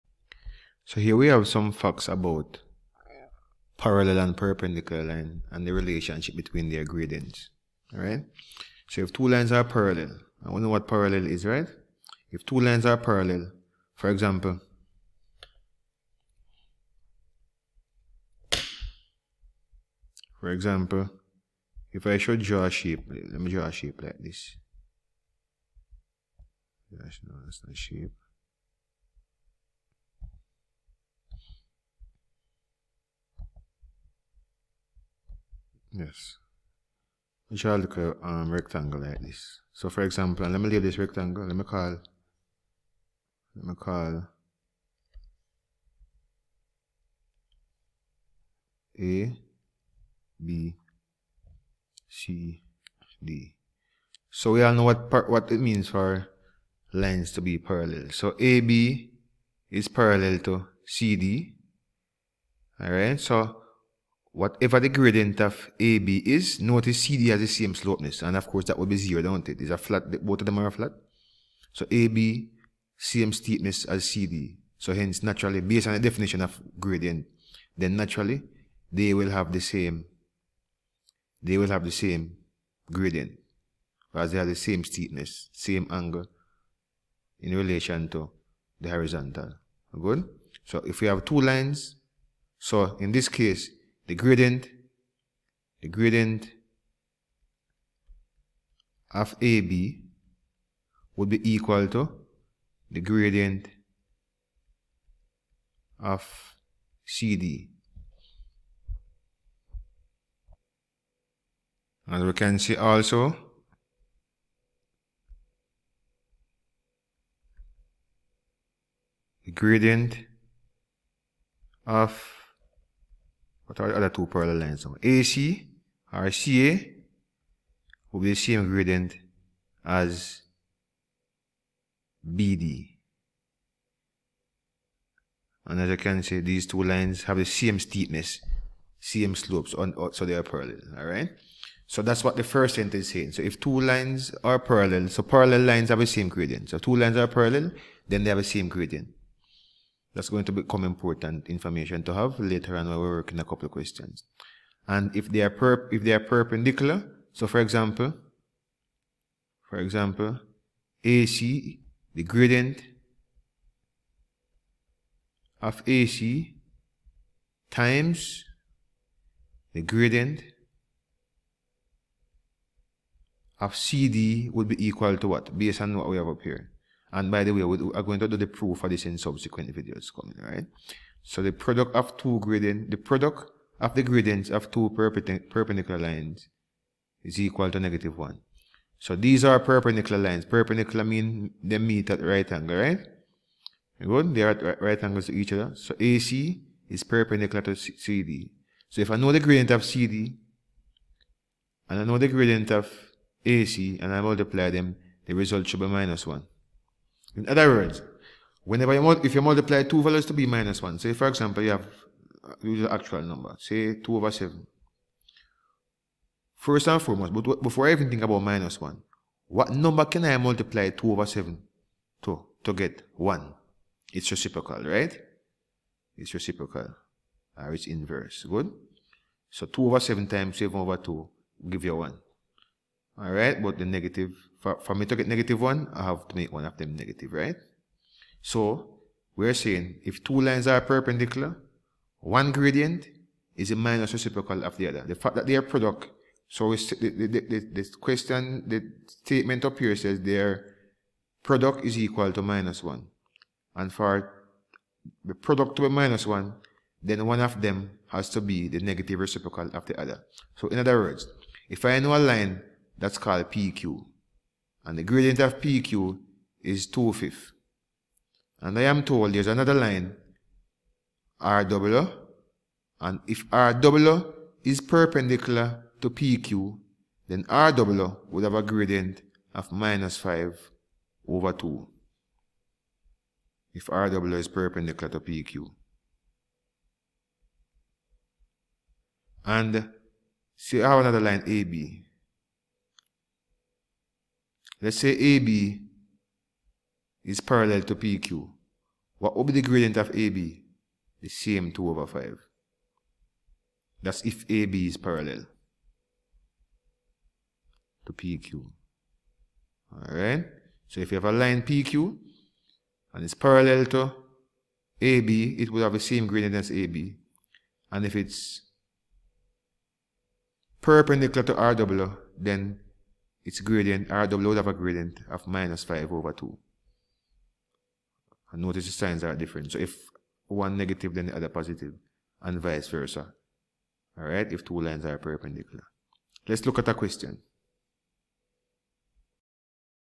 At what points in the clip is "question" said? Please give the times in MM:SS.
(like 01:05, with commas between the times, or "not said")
02:33, 04:08, 05:36.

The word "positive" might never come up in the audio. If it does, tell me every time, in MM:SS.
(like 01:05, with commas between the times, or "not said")
05:31.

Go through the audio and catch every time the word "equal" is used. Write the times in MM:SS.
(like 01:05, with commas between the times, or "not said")
01:41, 02:54, 03:07, 04:11.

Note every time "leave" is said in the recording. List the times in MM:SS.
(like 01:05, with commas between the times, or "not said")
00:40.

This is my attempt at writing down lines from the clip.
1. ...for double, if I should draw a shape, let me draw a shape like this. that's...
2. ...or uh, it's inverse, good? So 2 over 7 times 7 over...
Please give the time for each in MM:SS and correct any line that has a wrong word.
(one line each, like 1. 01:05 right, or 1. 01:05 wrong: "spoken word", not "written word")
1. 00:20 wrong: "example", not "double"
2. 03:47 right.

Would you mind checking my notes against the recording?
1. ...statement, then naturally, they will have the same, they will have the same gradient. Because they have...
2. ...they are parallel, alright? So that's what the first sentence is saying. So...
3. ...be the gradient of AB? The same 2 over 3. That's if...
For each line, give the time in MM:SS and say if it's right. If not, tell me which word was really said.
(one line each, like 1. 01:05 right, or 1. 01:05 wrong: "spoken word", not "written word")
1. 01:16 wrong: "gradient", not "statement"
2. 02:20 right
3. 04:59 wrong: "5", not "3".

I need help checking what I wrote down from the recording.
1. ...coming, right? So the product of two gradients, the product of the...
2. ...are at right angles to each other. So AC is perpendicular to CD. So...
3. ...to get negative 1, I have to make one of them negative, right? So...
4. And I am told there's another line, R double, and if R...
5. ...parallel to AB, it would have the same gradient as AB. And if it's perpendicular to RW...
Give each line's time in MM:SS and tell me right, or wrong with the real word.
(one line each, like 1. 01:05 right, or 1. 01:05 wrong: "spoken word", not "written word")
1. 03:00 right
2. 03:14 right
3. 03:55 right
4. 04:28 right
5. 05:13 right.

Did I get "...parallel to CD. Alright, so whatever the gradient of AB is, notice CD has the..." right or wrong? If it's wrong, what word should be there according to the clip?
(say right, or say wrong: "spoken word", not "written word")
right.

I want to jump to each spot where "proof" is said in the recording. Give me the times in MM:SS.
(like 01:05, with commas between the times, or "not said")
02:58.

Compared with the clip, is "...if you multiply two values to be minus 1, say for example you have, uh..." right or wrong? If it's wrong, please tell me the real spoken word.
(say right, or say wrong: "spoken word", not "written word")
right.